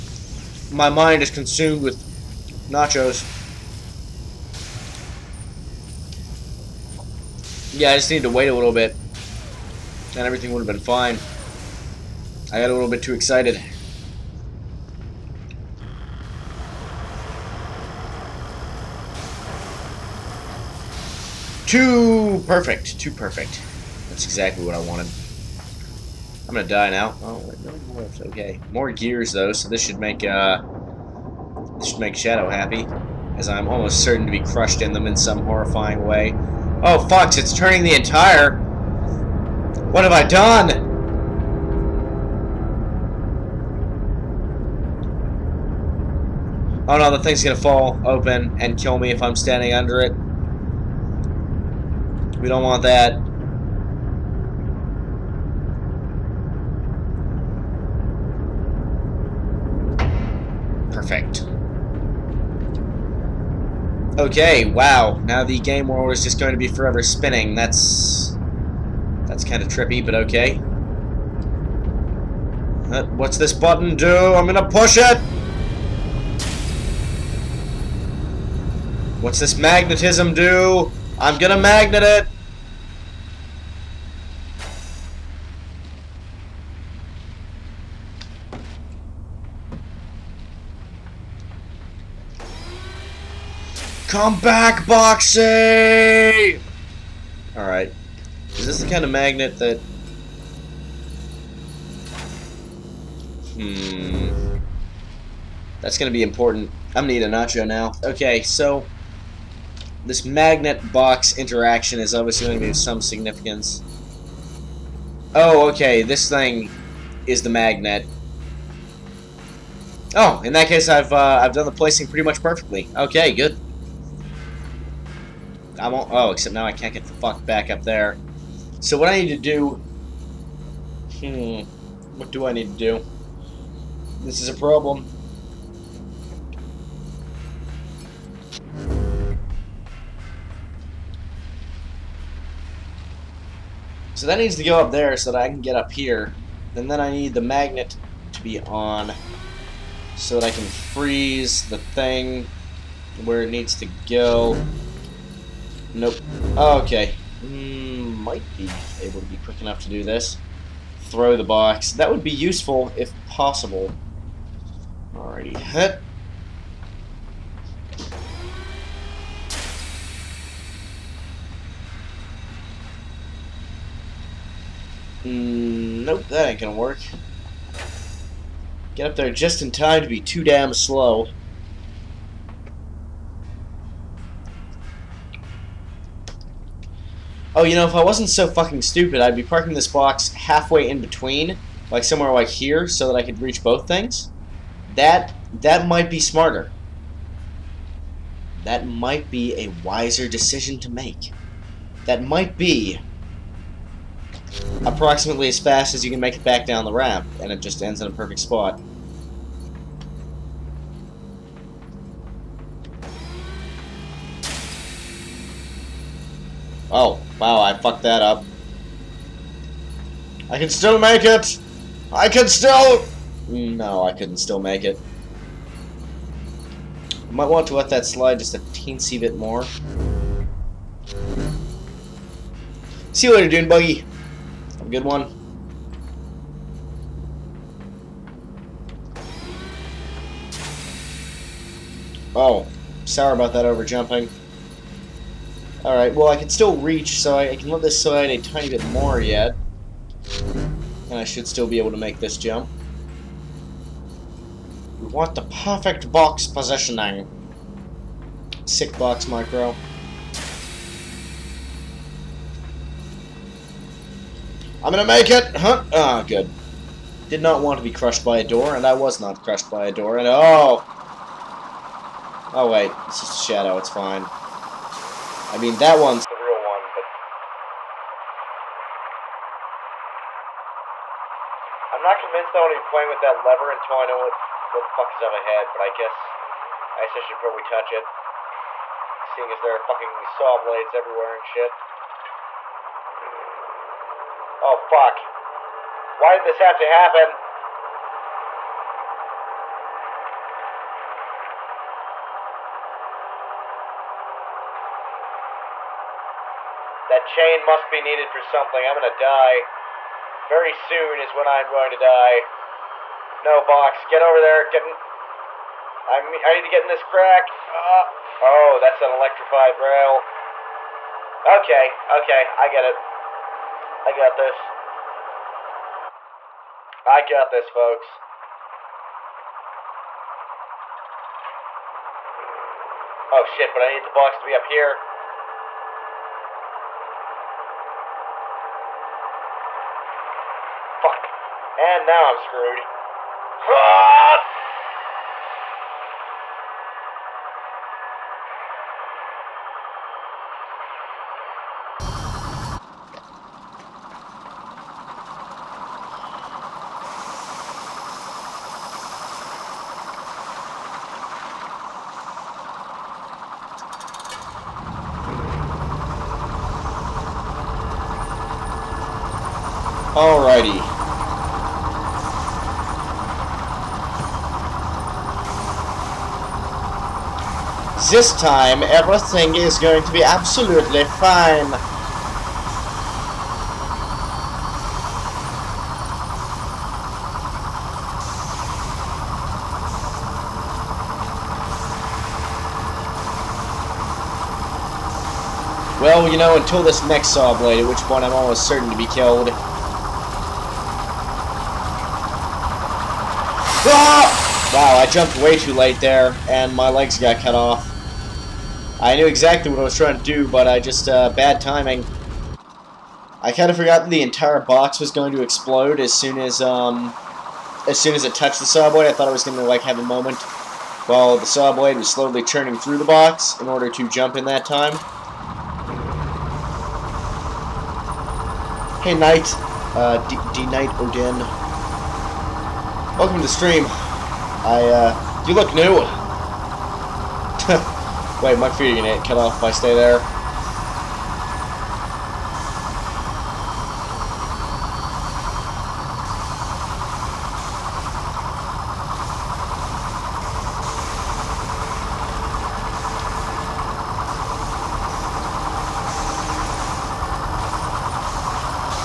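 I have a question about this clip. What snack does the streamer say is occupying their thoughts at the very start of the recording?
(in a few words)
Nachos.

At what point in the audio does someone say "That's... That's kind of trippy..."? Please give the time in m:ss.
1:07.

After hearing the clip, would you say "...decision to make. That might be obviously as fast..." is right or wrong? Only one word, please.
wrong.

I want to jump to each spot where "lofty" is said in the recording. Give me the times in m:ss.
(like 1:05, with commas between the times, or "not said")
not said.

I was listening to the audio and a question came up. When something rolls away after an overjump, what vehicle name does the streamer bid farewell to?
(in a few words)
Dune Buggy.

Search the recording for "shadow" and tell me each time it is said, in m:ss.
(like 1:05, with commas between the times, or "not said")
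0:32, 4:33.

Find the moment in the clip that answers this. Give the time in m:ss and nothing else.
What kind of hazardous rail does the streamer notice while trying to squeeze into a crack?
5:19.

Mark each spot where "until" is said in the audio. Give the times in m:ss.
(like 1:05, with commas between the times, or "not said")
4:43, 6:36.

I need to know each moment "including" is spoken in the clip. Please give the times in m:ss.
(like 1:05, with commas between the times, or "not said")
not said.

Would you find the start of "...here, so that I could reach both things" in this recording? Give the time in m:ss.
3:12.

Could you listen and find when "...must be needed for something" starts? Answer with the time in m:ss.
5:07.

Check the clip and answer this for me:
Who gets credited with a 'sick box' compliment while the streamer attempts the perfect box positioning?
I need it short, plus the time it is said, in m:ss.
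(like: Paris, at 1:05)
Micro, at 4:19.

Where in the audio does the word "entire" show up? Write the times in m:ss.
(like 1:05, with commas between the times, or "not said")
0:37, 6:54.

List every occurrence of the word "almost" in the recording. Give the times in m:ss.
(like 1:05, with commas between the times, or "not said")
0:33, 6:38.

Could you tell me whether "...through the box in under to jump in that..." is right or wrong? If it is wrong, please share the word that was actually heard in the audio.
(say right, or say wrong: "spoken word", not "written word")
wrong: "order", not "under".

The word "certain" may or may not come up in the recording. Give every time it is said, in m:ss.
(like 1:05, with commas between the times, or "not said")
0:34, 6:38.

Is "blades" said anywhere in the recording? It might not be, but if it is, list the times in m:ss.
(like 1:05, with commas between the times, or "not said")
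4:50, 6:37.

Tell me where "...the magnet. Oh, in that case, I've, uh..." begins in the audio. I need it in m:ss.
1:57.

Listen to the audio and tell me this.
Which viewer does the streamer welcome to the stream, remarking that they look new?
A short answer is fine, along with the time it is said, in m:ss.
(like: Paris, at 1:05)
D Knight Odin, at 7:10.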